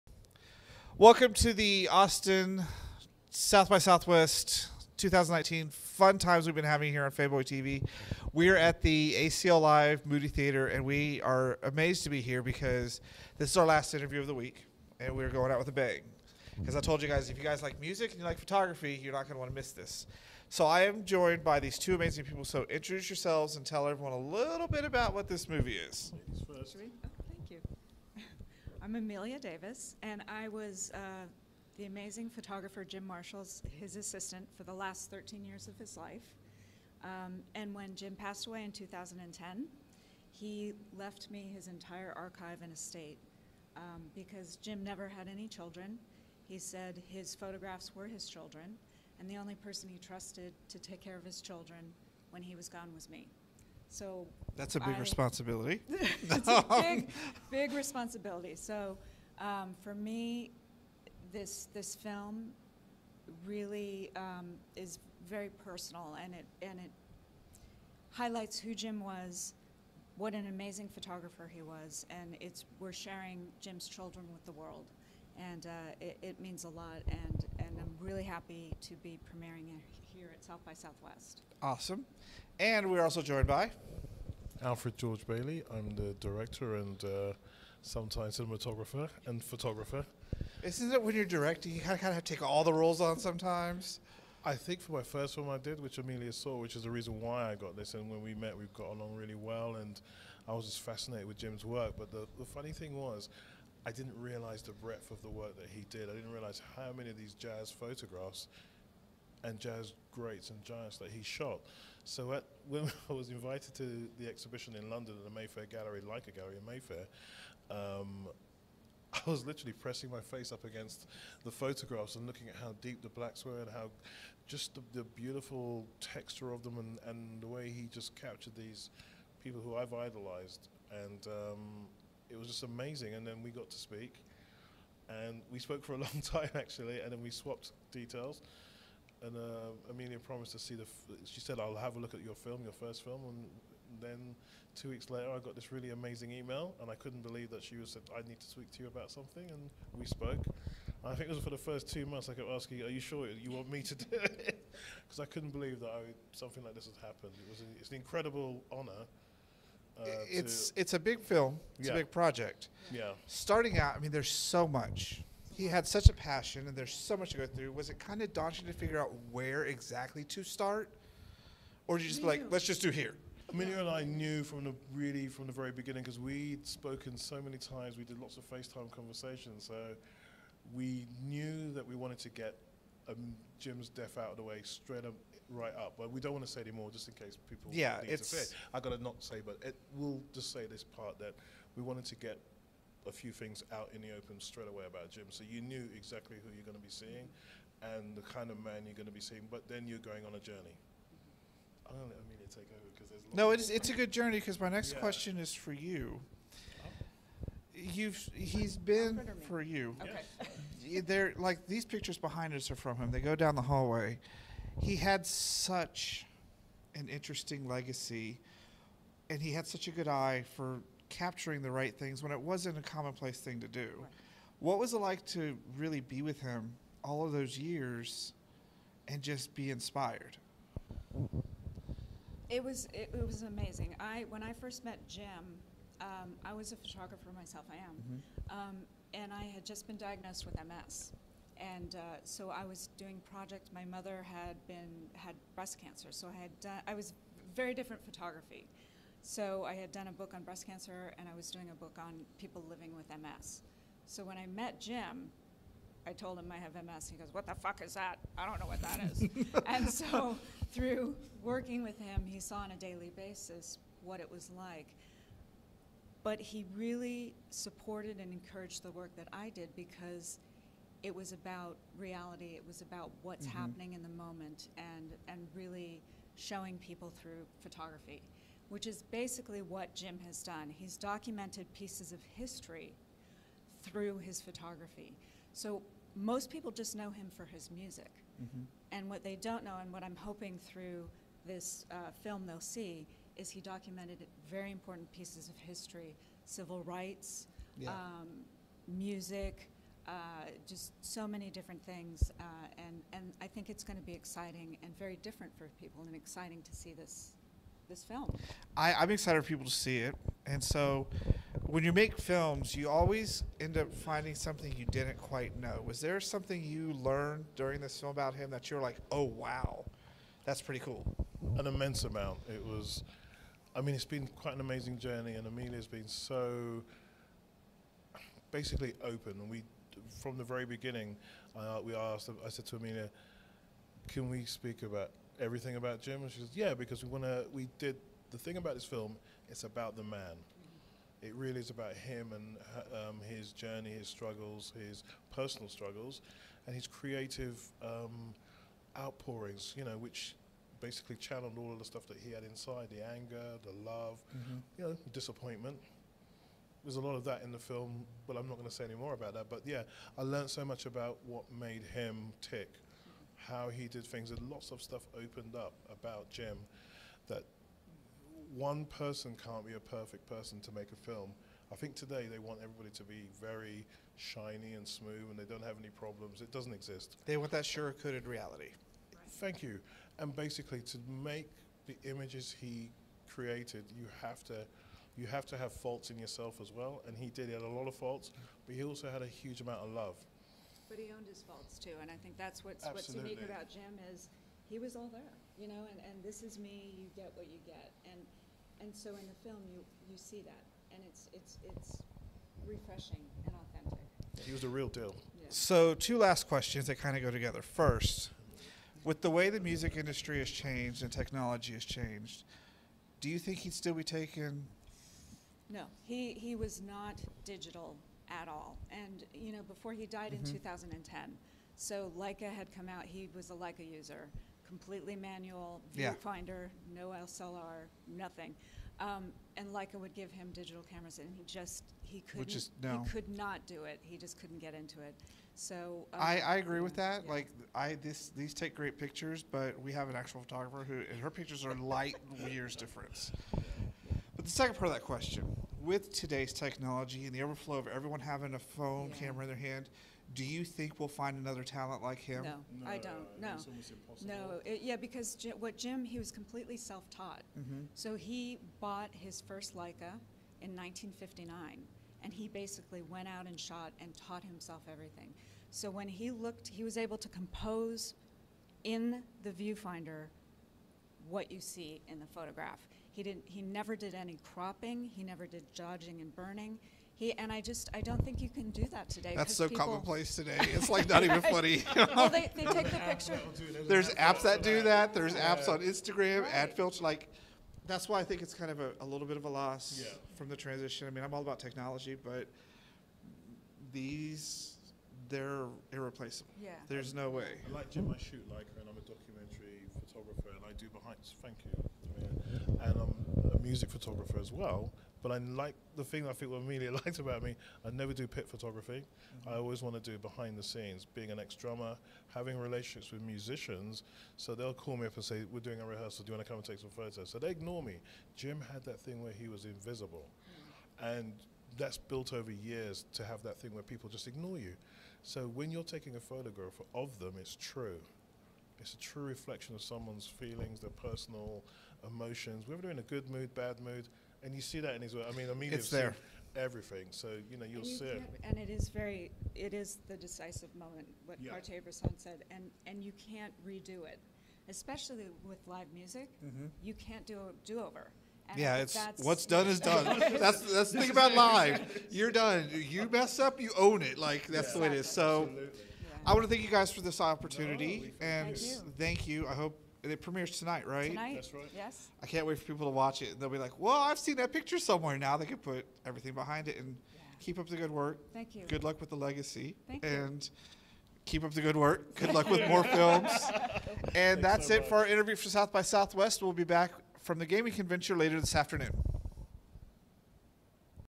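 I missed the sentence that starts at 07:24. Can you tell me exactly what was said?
But the second part of that question, with today's technology and the overflow of everyone having a phone yeah.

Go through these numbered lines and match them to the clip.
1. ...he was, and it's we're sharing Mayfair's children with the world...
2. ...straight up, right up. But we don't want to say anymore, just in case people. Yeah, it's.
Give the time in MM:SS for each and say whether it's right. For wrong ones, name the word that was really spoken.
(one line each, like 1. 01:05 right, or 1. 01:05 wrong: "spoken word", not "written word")
1. 01:11 wrong: "Jim", not "Mayfair"
2. 03:04 right.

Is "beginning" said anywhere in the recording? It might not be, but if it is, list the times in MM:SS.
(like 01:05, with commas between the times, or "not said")
02:55, 05:30.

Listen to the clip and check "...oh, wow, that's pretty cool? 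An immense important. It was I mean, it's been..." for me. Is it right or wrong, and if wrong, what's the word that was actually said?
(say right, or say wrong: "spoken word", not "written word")
wrong: "amount", not "important".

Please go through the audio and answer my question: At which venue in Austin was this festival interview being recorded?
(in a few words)
ACL Live Moody Theater.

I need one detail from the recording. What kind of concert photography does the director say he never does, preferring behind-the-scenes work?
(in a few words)
Pit photography.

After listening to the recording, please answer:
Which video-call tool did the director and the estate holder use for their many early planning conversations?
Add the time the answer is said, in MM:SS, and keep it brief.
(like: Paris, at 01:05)
FaceTime, at 02:58.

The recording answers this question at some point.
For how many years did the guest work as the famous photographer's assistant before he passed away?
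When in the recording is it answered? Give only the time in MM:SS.
00:35.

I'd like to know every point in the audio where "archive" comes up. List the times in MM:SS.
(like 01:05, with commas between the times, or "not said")
00:42.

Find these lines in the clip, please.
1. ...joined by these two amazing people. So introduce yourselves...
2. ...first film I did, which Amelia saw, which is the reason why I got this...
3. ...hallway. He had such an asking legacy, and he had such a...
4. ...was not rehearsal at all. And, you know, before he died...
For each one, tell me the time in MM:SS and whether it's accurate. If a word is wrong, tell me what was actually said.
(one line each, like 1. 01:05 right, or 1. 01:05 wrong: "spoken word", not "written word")
1. 00:21 right
2. 01:35 right
3. 03:33 wrong: "interesting", not "asking"
4. 06:56 wrong: "digital", not "rehearsal".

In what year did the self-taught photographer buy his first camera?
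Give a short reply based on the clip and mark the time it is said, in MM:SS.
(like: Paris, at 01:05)
1959, at 07:40.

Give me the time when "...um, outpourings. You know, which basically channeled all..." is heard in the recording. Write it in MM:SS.
05:47.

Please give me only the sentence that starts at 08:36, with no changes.
Do you want to come and take some photos?" So they ignore me.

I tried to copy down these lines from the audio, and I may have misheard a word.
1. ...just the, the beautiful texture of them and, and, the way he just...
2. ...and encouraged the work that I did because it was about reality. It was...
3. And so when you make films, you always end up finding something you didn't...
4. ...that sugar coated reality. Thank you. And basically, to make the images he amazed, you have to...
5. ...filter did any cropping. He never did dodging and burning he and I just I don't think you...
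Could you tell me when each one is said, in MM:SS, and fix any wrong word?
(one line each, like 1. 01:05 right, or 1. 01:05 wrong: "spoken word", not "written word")
1. 02:04 right
2. 04:28 right
3. 05:10 right
4. 06:17 wrong: "created", not "amazed"
5. 07:53 wrong: "never", not "filter".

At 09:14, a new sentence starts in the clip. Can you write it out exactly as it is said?
Like that's yeah, the way it is.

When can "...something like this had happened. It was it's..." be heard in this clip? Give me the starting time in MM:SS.
02:36.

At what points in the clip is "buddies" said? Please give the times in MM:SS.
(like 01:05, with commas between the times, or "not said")
not said.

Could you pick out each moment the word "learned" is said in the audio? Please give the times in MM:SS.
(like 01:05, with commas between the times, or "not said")
05:16, 06:00.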